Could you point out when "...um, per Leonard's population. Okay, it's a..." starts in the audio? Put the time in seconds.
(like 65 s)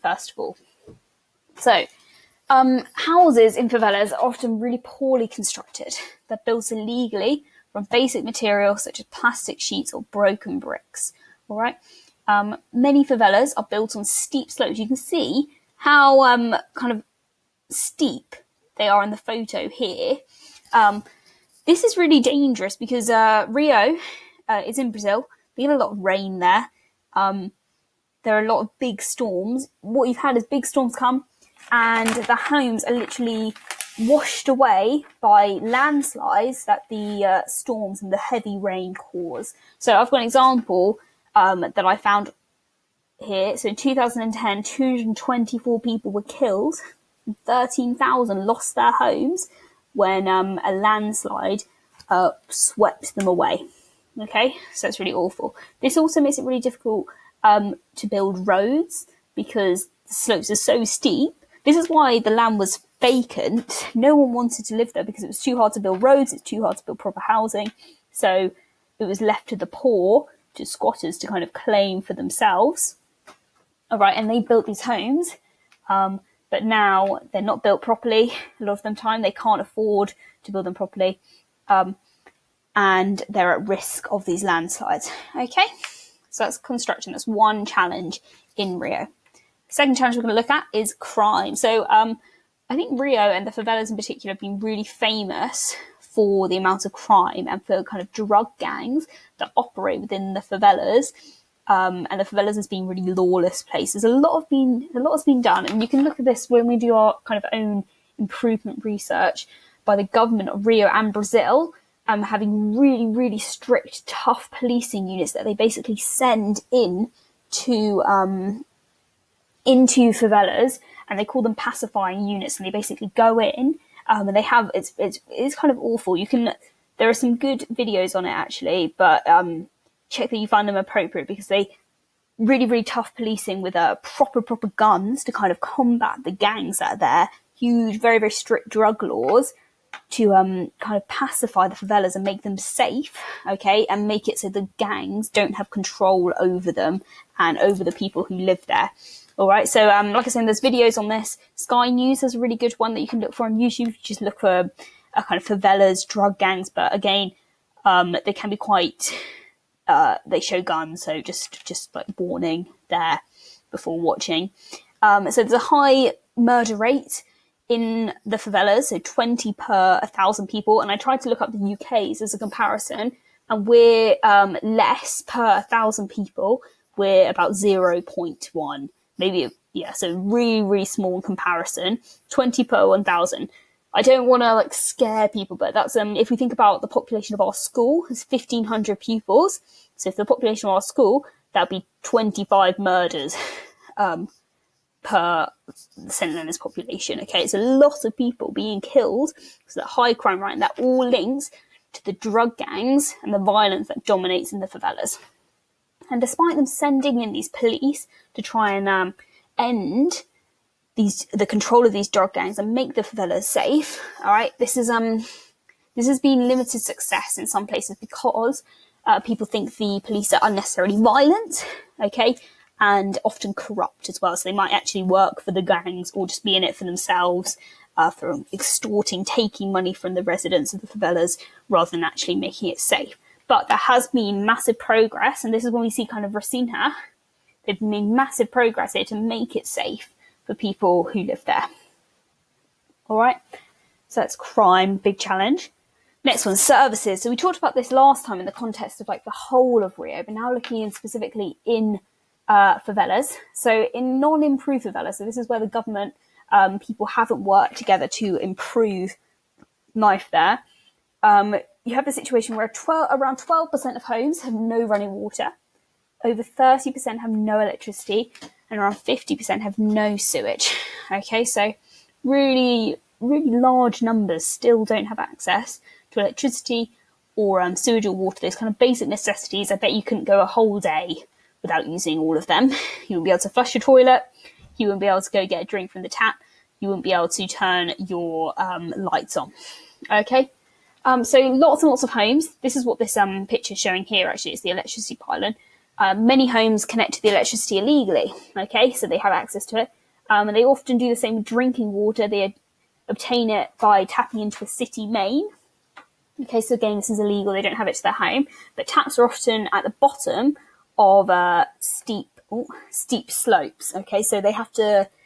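193 s.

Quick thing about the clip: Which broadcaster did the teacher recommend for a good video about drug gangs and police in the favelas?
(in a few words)
Sky News.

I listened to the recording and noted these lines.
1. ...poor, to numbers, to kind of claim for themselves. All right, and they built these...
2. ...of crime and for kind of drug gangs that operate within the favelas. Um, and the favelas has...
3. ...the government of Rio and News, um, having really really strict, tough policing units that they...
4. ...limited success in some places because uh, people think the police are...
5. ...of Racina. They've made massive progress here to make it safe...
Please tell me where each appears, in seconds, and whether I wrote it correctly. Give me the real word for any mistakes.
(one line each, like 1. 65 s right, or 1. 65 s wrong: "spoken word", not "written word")
1. 69 s wrong: "squatters", not "numbers"
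2. 96 s right
3. 109 s wrong: "Brazil", not "News"
4. 216 s right
5. 236 s right.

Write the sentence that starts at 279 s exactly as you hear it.
I bet you couldn't go a whole day without using all of them.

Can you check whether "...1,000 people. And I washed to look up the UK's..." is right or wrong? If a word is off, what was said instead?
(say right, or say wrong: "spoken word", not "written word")
wrong: "tried", not "washed".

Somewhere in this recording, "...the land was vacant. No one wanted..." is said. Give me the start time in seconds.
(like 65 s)
62 s.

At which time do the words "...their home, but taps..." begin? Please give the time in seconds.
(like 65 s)
308 s.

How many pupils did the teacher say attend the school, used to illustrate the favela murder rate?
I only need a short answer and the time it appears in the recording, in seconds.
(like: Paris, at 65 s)
1500, at 188 s.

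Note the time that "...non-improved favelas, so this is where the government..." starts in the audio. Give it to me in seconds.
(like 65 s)
254 s.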